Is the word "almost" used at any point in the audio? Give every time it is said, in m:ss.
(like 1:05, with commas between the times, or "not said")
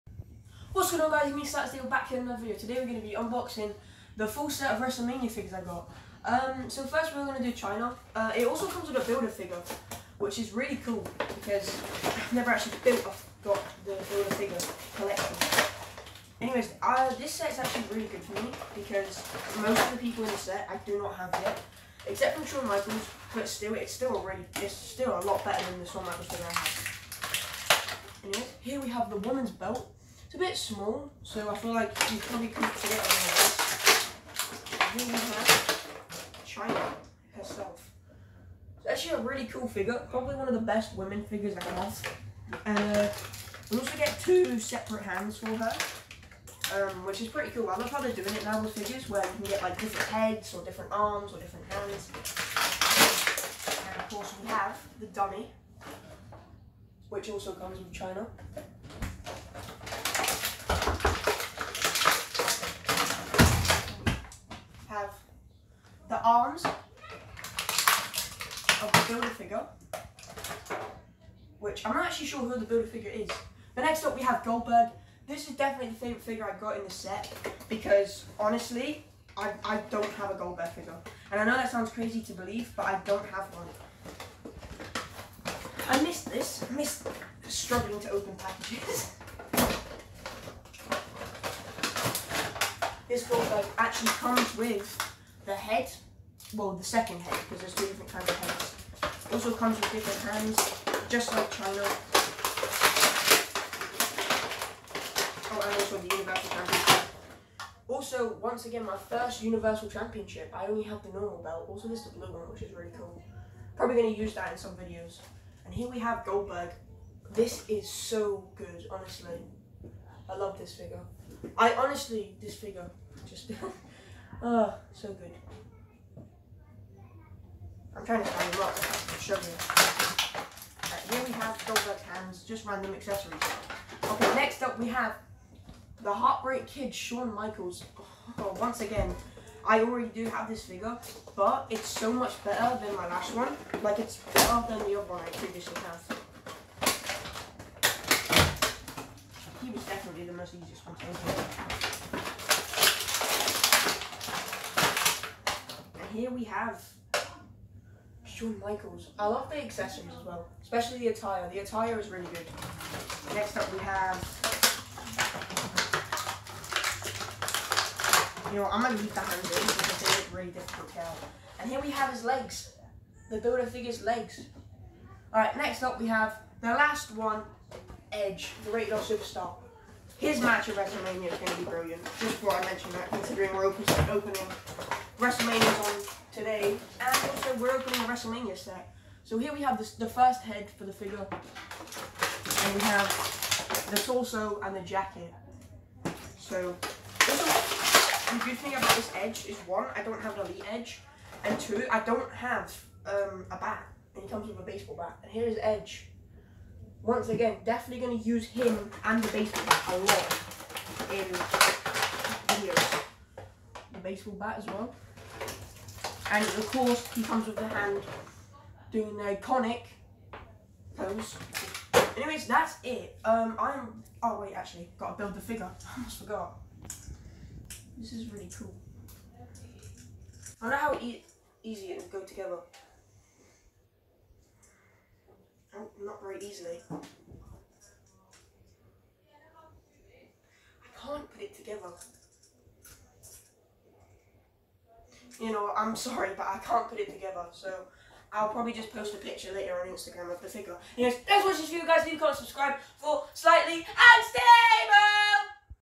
3:45.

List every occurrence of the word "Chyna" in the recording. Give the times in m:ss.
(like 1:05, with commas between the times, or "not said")
0:07, 0:36, 0:57, 1:41.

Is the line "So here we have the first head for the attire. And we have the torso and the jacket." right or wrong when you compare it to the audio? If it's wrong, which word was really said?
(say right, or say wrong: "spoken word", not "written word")
wrong: "figure", not "attire".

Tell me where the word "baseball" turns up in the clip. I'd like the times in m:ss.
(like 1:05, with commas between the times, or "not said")
3:24, 3:29, 3:34.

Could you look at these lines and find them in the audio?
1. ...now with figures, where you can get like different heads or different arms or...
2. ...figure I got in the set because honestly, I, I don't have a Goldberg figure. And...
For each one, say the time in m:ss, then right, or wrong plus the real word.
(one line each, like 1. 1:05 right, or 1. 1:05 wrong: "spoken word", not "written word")
1. 0:48 right
2. 1:16 right.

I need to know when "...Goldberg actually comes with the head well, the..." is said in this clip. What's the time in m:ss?
1:33.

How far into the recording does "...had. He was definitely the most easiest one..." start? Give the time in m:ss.
2:25.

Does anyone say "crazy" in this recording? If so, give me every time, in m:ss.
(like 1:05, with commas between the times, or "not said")
1:21.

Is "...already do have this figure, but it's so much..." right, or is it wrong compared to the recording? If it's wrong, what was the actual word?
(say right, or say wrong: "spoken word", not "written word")
right.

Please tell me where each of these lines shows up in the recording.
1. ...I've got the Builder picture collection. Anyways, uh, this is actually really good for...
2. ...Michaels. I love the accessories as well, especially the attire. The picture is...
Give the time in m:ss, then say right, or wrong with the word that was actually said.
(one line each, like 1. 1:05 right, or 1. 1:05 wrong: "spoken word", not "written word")
1. 0:13 wrong: "figure", not "picture"
2. 2:38 wrong: "attire", not "picture".